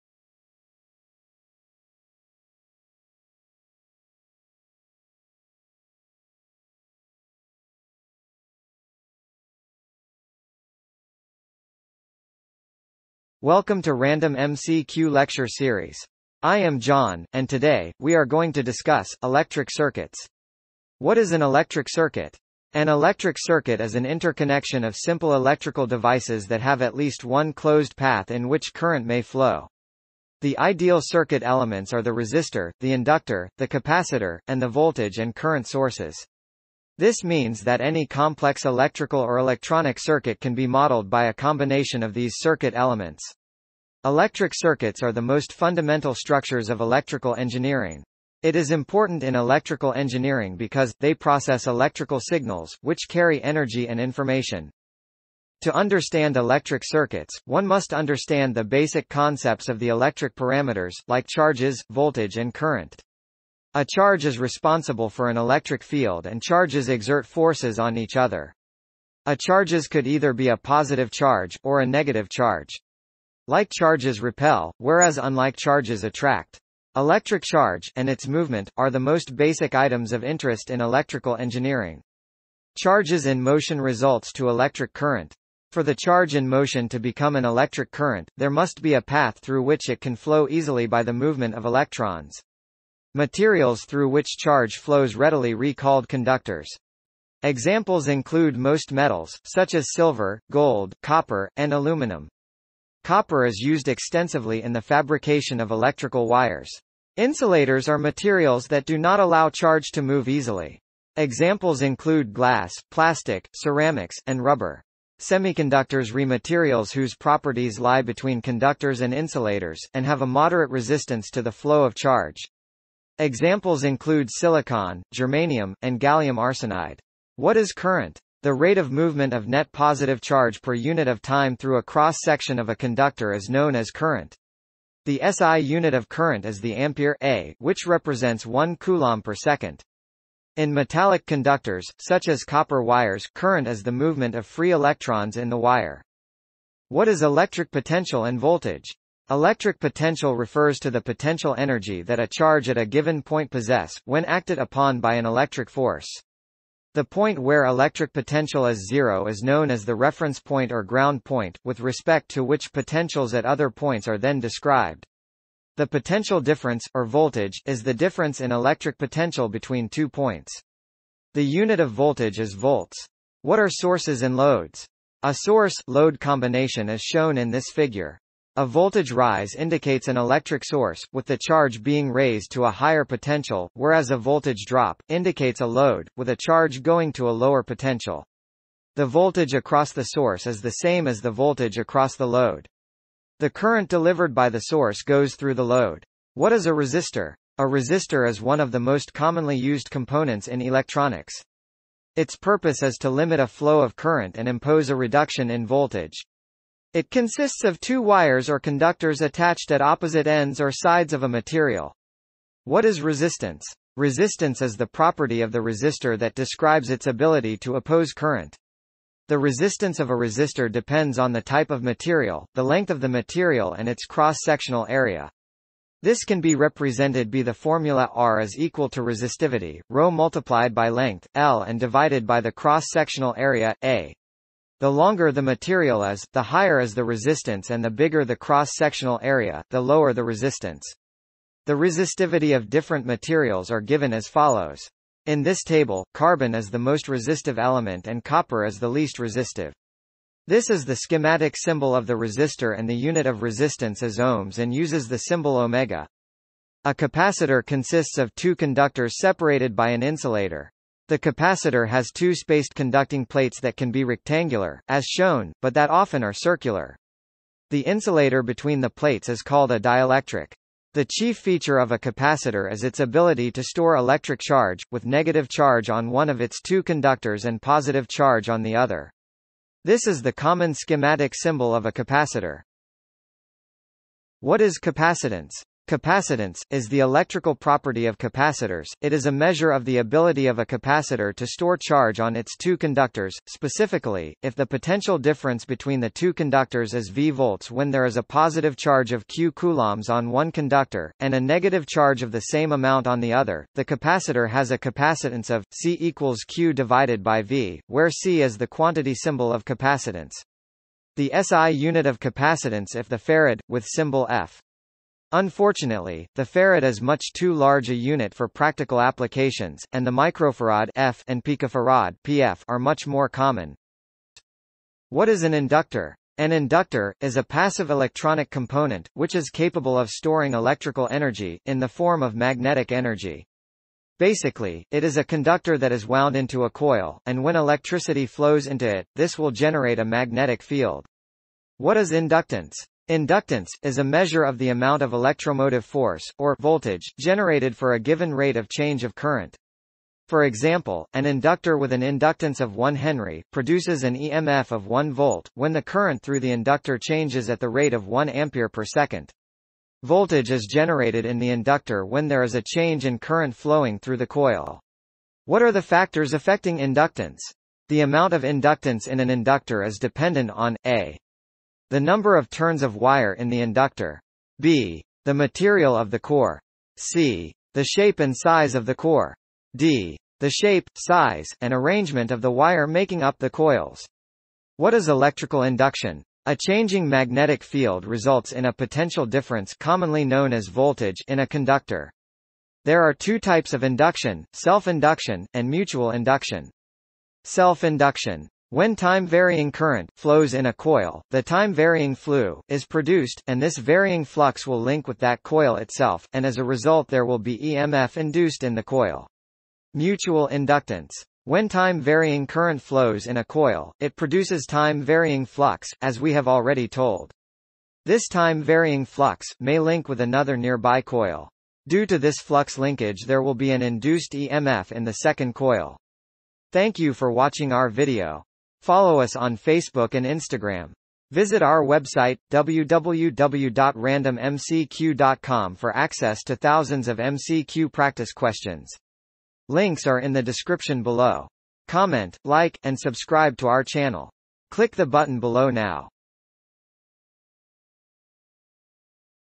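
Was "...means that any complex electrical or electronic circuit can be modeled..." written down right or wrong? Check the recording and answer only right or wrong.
right.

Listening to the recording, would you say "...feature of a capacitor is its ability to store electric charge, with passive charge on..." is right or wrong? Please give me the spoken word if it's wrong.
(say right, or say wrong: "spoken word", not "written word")
wrong: "negative", not "passive".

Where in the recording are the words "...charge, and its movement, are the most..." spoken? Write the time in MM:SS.
01:17.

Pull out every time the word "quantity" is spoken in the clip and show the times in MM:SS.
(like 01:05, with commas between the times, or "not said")
05:08.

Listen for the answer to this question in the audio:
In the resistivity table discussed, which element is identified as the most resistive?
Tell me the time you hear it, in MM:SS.
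04:06.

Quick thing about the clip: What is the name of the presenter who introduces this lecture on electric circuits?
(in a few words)
John.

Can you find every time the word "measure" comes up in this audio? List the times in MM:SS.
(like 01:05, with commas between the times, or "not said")
04:49, 05:44.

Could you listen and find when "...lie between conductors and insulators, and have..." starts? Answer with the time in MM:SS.
01:57.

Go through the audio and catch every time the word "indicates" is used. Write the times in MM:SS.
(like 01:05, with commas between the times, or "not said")
02:59, 03:05.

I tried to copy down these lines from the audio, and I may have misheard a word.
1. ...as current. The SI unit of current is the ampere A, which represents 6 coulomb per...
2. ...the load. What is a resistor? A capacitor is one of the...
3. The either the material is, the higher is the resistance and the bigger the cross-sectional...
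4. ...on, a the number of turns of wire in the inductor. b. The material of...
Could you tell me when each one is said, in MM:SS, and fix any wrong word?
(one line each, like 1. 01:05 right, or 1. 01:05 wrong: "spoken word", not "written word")
1. 02:13 wrong: "1", not "6"
2. 03:15 wrong: "resistor", not "capacitor"
3. 03:54 wrong: "longer", not "either"
4. 06:10 right.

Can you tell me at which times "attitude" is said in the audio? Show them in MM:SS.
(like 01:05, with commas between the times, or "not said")
not said.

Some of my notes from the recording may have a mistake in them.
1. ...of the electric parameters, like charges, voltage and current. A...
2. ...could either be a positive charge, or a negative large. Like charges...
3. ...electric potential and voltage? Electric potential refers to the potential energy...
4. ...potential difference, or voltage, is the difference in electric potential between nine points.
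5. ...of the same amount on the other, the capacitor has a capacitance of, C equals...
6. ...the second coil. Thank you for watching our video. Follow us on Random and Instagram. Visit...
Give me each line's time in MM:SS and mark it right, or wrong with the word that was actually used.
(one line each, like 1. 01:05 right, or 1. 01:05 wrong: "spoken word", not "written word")
1. 00:59 right
2. 01:09 wrong: "charge", not "large"
3. 02:27 right
4. 02:45 wrong: "two", not "nine"
5. 05:02 right
6. 07:05 wrong: "Facebook", not "Random".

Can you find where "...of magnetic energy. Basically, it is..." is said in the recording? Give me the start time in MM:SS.
05:32.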